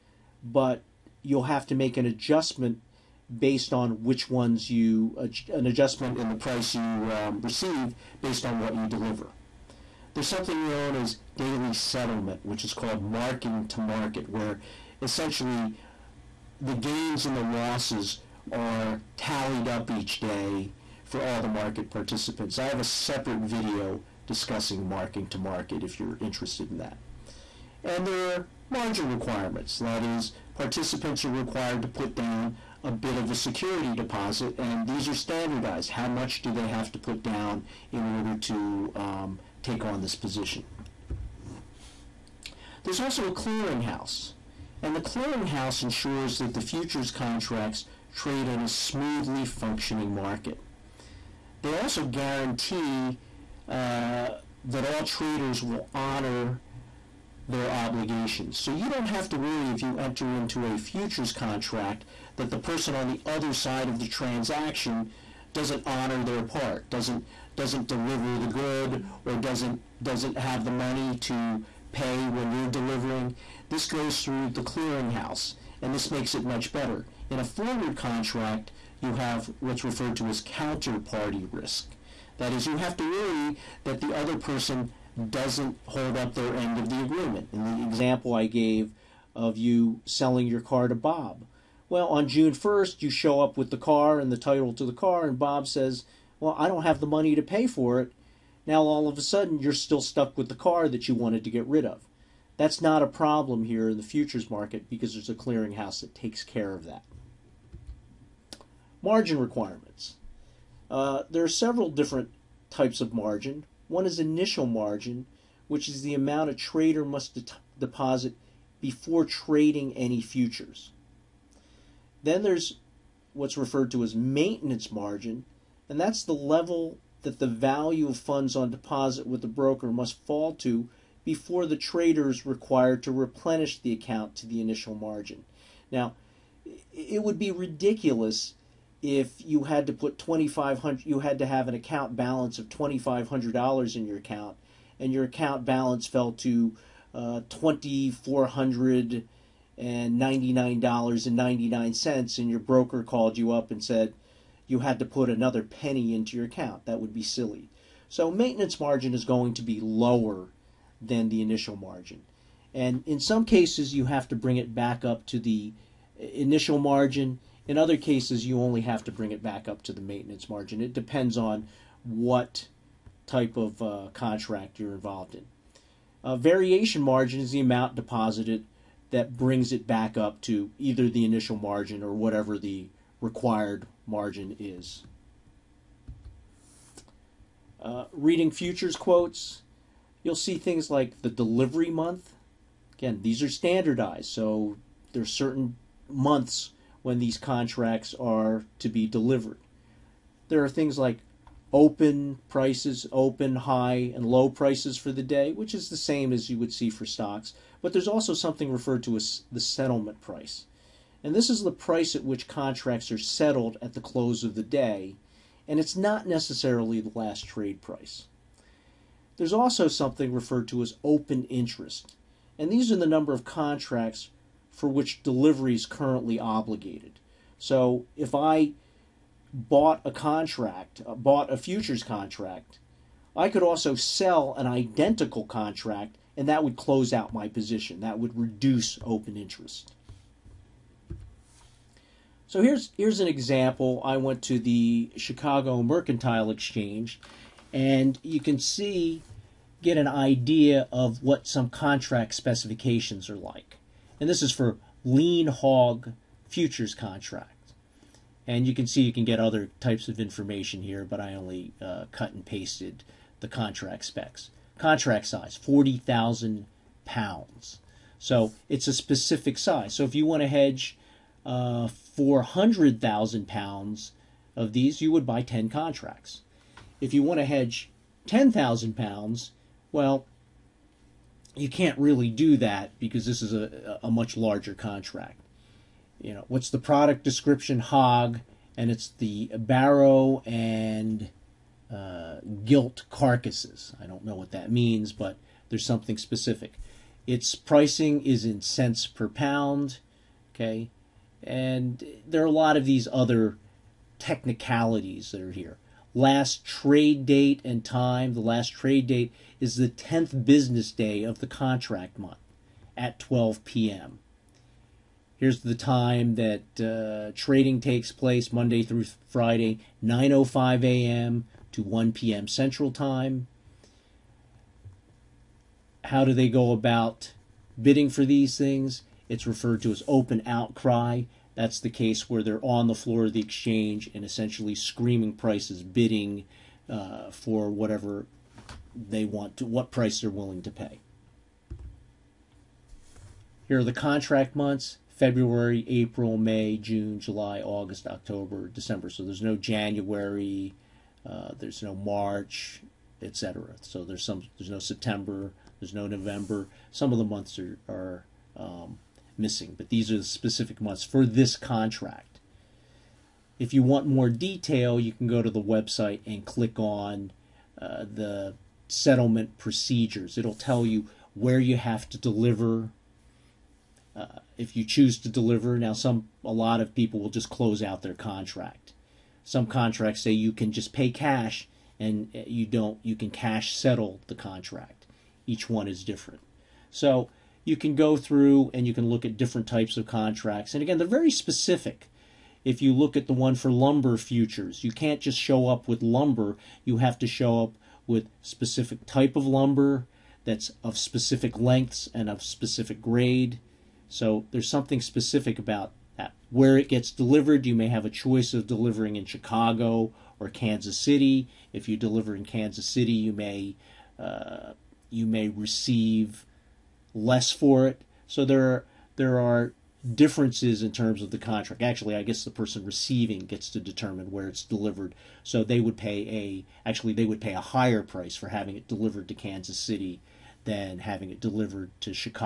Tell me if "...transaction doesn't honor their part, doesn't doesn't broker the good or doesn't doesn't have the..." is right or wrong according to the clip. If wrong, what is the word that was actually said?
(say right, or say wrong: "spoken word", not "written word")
wrong: "deliver", not "broker".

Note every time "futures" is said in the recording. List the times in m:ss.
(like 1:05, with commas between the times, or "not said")
0:46, 1:00, 1:44, 2:00, 3:08, 3:51, 4:16, 6:34.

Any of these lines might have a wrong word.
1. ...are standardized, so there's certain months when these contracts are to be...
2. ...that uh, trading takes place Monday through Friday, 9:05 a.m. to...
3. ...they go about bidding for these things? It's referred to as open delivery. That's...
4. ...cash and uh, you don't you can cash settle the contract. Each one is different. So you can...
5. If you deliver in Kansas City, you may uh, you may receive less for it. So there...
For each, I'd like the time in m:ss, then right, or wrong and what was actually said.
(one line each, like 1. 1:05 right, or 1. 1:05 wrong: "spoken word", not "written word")
1. 3:13 right
2. 5:16 right
3. 5:26 wrong: "outcry", not "delivery"
4. 6:21 right
5. 6:51 right.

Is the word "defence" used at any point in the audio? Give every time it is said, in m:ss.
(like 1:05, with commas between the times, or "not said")
not said.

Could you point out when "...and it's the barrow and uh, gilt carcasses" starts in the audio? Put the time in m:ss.
4:48.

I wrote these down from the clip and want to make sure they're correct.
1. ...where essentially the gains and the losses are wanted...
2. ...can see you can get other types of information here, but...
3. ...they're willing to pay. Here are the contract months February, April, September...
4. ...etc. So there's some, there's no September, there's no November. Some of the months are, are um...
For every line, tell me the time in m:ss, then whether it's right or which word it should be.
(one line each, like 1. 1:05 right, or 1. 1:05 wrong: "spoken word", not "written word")
1. 0:14 wrong: "tallied", not "wanted"
2. 4:18 right
3. 5:40 wrong: "May", not "September"
4. 5:53 right.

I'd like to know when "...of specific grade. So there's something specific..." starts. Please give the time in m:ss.
6:42.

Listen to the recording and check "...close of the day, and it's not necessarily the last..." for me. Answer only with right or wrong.
right.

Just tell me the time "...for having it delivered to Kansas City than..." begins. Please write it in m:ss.
7:08.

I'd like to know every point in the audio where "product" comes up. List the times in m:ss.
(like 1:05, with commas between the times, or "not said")
4:46.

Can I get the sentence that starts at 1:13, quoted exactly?
This goes through the clearinghouse and this makes it much better.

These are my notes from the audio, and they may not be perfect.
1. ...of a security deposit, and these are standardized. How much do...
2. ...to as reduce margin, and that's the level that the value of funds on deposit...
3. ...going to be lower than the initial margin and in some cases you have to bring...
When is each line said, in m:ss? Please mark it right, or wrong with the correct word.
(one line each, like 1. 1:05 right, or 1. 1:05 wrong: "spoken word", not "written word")
1. 0:33 right
2. 2:03 wrong: "maintenance", not "reduce"
3. 2:39 right.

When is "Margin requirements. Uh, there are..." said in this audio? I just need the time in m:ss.
1:49.